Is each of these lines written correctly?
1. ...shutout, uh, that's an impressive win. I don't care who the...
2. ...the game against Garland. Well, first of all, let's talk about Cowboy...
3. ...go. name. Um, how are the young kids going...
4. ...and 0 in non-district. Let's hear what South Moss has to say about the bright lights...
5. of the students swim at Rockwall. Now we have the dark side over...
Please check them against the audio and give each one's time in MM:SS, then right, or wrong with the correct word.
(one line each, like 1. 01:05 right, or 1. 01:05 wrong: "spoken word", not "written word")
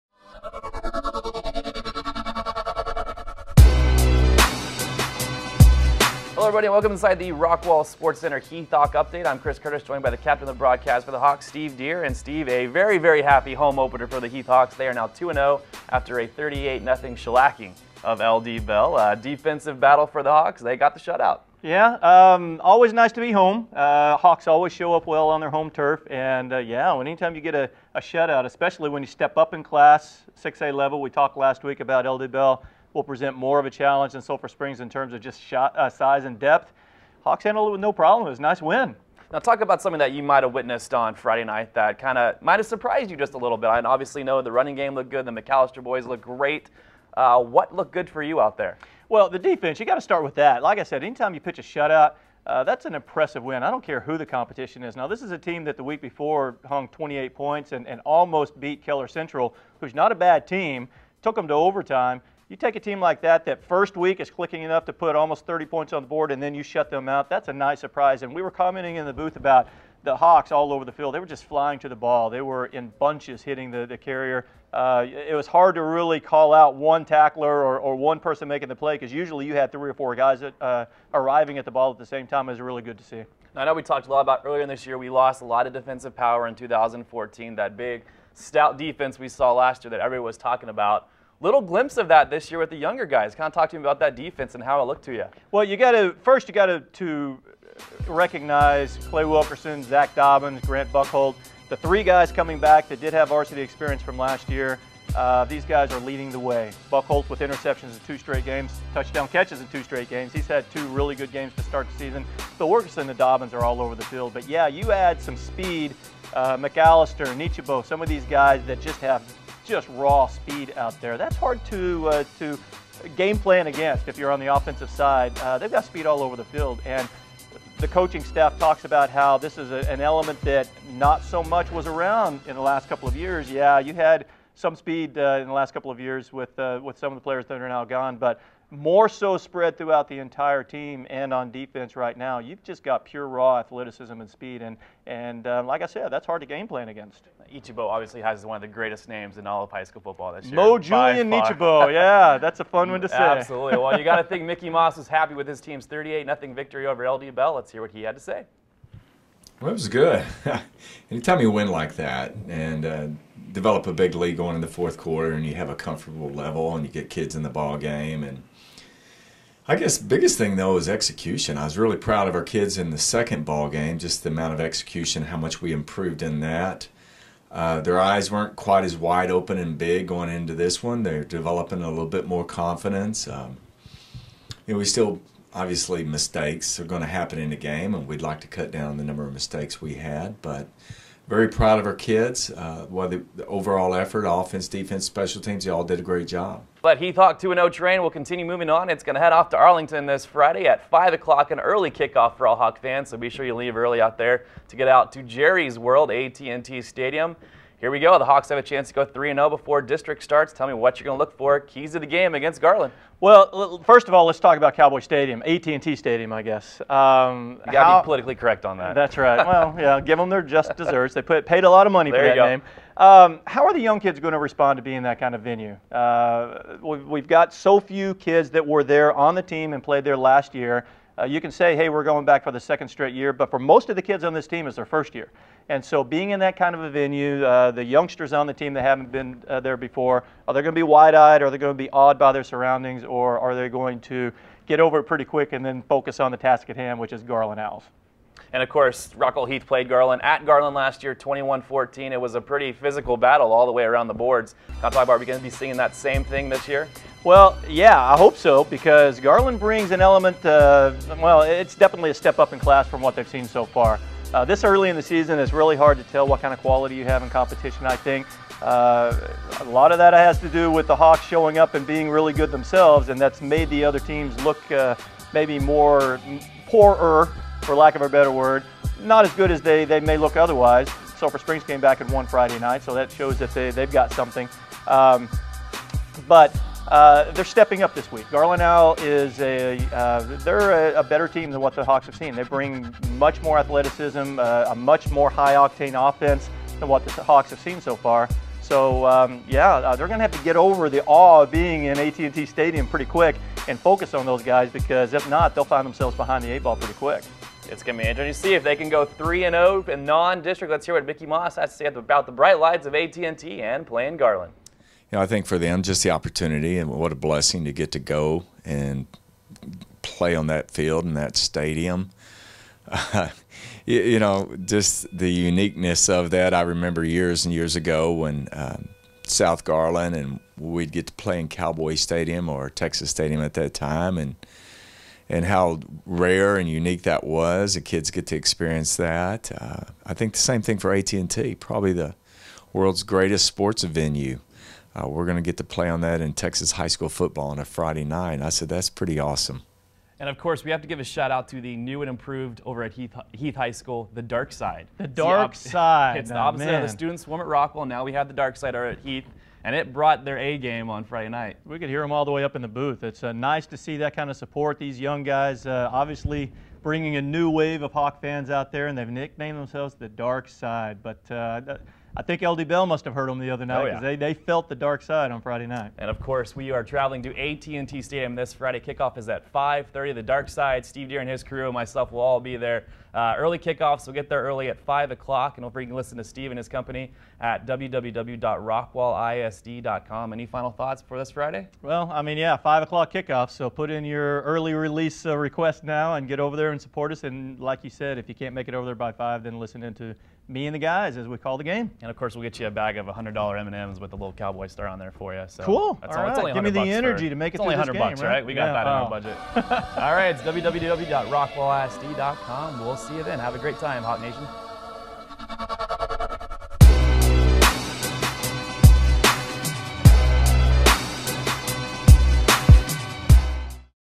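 1. 00:51 right
2. 03:31 right
3. 03:42 right
4. 05:09 wrong: "Mickey", not "South"
5. 05:56 right.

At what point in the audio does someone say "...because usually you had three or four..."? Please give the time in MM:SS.
01:18.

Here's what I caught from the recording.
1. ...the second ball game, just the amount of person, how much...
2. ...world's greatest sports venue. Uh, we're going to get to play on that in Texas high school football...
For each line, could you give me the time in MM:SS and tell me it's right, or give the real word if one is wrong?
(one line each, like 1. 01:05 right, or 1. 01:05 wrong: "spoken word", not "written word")
1. 02:52 wrong: "execution", not "person"
2. 05:42 right.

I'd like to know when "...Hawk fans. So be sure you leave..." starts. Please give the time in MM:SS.
03:22.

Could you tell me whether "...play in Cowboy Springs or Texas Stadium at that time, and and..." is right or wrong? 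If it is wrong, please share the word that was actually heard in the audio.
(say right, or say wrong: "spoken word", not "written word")
wrong: "Stadium", not "Springs".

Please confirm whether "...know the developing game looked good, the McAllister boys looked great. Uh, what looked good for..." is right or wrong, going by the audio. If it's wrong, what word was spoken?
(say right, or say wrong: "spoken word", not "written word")
wrong: "running", not "developing".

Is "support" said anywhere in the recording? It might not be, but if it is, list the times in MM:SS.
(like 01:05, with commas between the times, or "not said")
06:04, 06:36.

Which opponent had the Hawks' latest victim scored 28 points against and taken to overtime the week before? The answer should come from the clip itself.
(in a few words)
Keller Central.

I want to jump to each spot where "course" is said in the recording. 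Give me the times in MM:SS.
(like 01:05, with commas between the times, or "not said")
04:08, 05:50, 06:16, 06:42.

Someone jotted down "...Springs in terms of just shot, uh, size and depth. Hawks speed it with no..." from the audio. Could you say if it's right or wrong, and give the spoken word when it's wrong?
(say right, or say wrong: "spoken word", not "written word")
wrong: "handled", not "speed".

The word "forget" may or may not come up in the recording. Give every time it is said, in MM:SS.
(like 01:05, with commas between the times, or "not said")
06:25.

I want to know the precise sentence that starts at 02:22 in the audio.
You've just got pure raw athleticism and speed, and and uh, like I said, that's hard to game plan against.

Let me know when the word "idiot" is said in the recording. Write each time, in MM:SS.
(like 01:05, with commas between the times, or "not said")
not said.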